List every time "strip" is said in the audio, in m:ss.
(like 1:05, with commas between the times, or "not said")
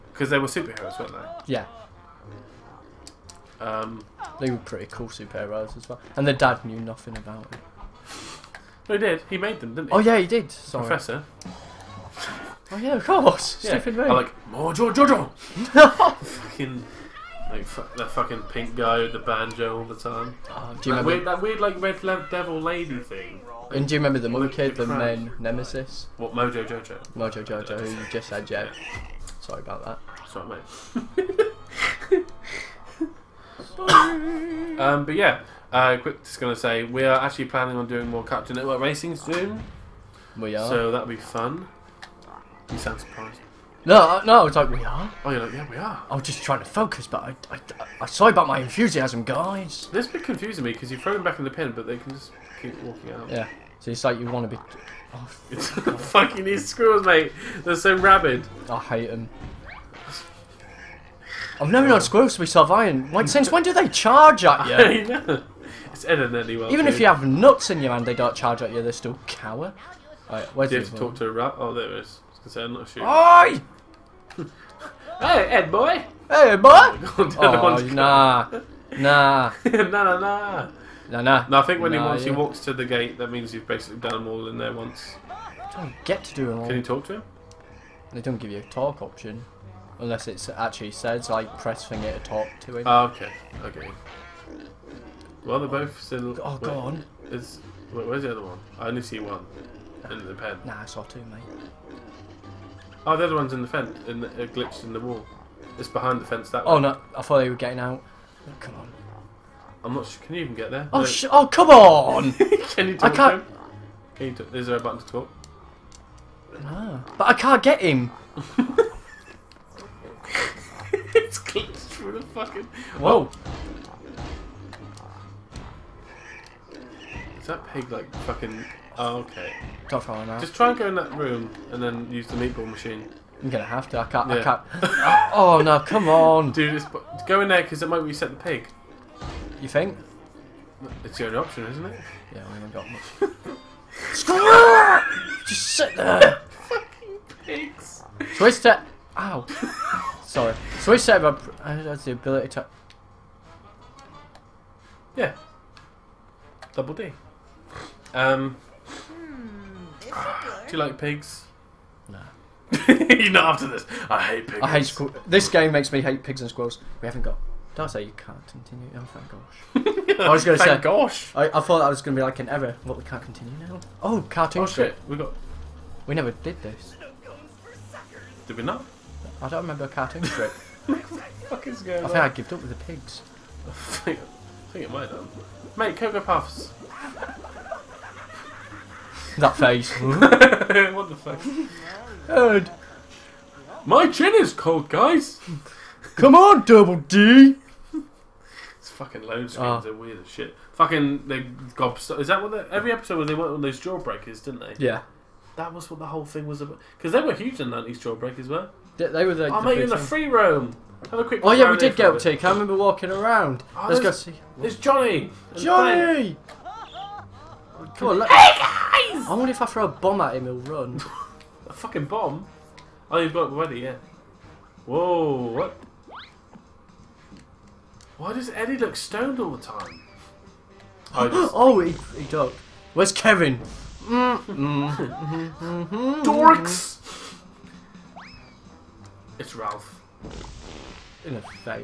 2:54, 3:00.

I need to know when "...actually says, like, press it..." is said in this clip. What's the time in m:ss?
1:30.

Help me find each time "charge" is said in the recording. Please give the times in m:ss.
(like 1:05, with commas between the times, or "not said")
1:03, 1:08.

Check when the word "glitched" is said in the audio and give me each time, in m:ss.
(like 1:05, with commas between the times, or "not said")
1:44, 2:01.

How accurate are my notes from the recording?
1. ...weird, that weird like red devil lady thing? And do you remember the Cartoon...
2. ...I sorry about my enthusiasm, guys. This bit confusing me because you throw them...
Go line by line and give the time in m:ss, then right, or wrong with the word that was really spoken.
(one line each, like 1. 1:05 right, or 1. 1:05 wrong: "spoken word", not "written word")
1. 0:21 wrong: "Monkey", not "Cartoon"
2. 0:48 right.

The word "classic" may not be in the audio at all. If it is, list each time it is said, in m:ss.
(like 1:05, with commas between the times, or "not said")
not said.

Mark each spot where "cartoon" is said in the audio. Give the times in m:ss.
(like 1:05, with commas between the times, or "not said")
0:38, 2:54, 2:59.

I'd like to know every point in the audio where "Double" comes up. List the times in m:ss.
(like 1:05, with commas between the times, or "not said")
2:36, 3:16.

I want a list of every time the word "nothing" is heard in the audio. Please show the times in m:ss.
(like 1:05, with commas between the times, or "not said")
0:06.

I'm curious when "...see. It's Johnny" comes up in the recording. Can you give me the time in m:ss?
3:34.